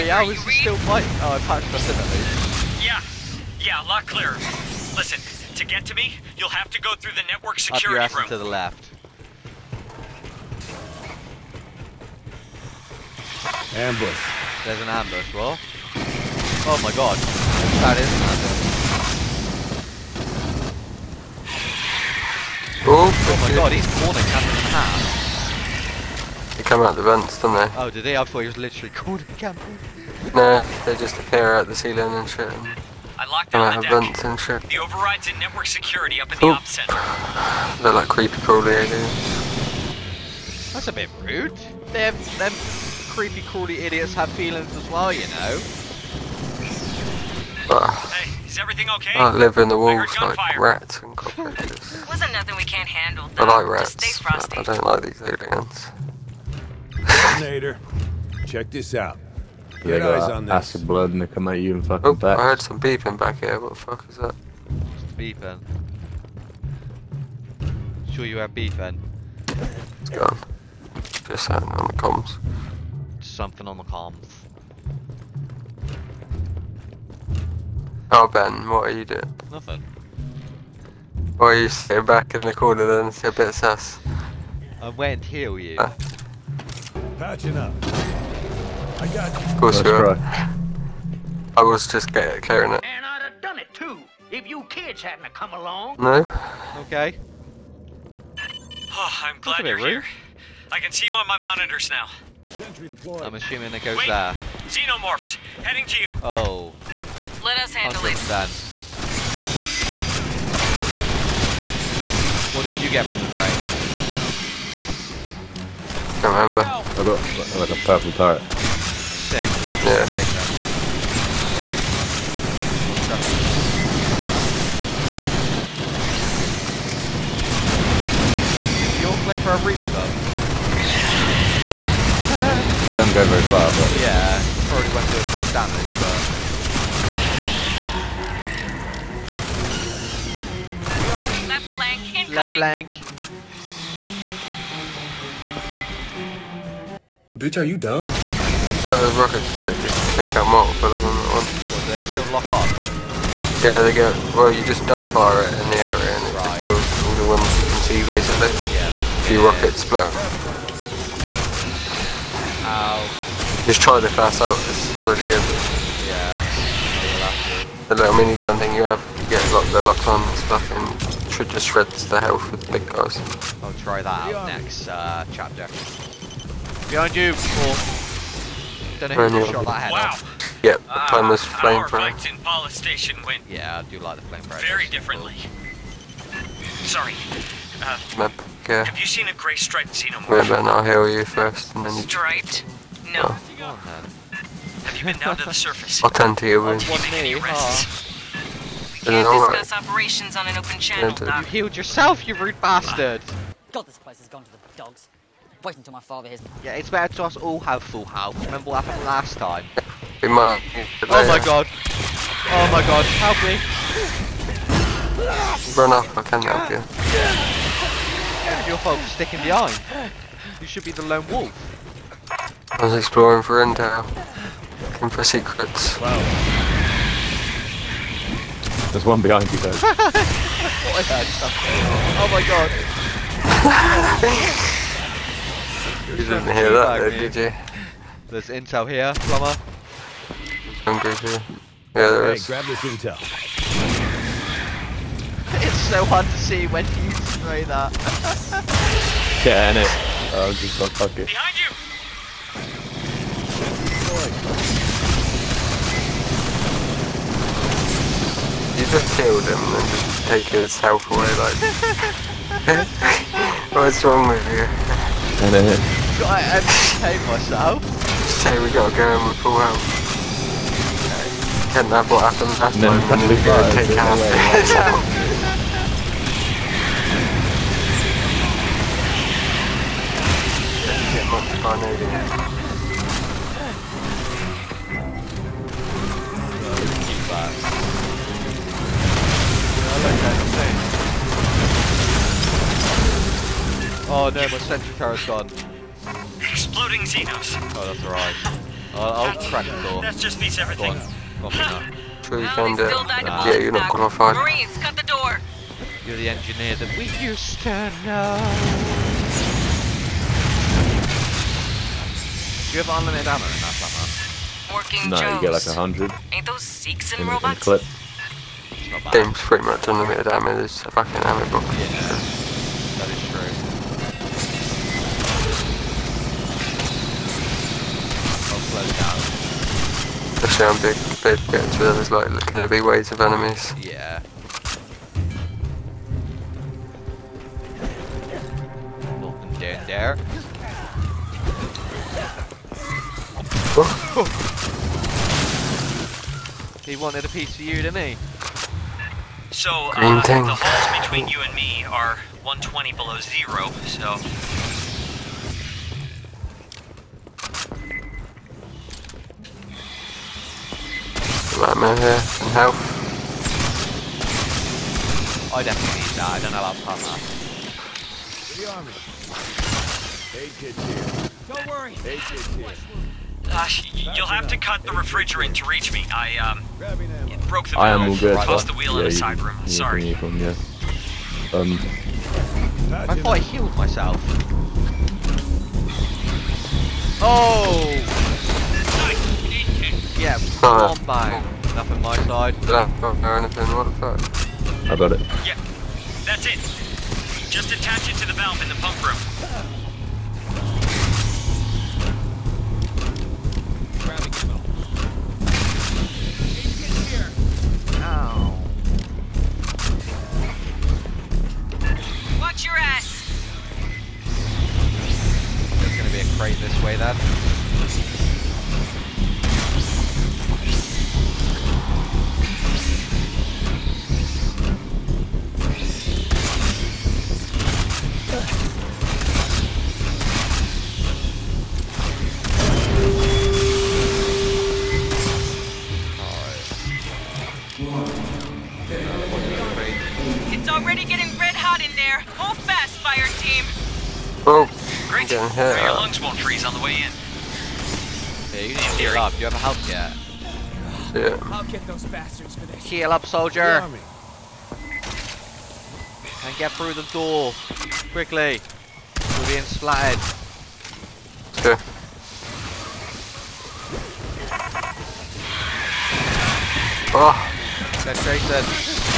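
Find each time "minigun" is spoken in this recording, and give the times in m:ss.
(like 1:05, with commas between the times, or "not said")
2:48.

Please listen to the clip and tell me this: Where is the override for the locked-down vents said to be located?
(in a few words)
The op center.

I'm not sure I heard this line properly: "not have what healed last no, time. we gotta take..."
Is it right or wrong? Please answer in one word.
wrong.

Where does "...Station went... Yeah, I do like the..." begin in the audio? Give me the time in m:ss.
3:02.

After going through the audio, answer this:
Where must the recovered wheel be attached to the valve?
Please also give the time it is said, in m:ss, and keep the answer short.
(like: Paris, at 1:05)
The pump room, at 6:38.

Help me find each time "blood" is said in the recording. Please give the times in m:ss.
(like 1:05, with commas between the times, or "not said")
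1:00.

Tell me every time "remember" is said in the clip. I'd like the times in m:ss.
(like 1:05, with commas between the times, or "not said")
1:56, 3:28.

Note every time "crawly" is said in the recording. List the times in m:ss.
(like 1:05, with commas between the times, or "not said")
0:38, 0:43.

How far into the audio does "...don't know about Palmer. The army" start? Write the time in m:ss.
6:06.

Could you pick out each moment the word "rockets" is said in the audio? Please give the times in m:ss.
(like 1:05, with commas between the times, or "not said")
2:29, 2:39.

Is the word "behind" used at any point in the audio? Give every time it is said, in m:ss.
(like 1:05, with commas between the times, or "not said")
2:56, 3:39, 3:49, 4:11.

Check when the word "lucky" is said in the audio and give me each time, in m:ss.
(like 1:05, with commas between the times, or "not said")
4:11.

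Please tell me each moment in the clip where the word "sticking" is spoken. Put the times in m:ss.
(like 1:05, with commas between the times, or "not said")
3:39.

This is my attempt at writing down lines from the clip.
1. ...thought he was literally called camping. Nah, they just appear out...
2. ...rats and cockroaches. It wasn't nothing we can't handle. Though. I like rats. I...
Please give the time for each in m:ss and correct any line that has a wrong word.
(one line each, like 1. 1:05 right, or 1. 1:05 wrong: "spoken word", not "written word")
1. 0:28 right
2. 0:50 right.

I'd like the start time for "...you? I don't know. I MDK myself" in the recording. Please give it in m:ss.
4:24.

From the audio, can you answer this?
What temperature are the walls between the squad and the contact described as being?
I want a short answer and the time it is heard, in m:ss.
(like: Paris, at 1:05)
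120 below zero, at 5:52.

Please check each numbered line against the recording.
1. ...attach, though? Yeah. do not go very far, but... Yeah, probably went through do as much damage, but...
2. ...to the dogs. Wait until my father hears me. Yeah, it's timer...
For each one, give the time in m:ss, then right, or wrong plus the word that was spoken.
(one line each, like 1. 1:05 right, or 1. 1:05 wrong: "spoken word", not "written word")
1. 2:09 wrong: "breach", not "attach"
2. 3:24 wrong: "better", not "timer".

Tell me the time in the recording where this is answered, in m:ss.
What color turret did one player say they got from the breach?
1:57.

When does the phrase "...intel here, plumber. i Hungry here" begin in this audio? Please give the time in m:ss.
3:58.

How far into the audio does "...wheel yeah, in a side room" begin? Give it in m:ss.
6:18.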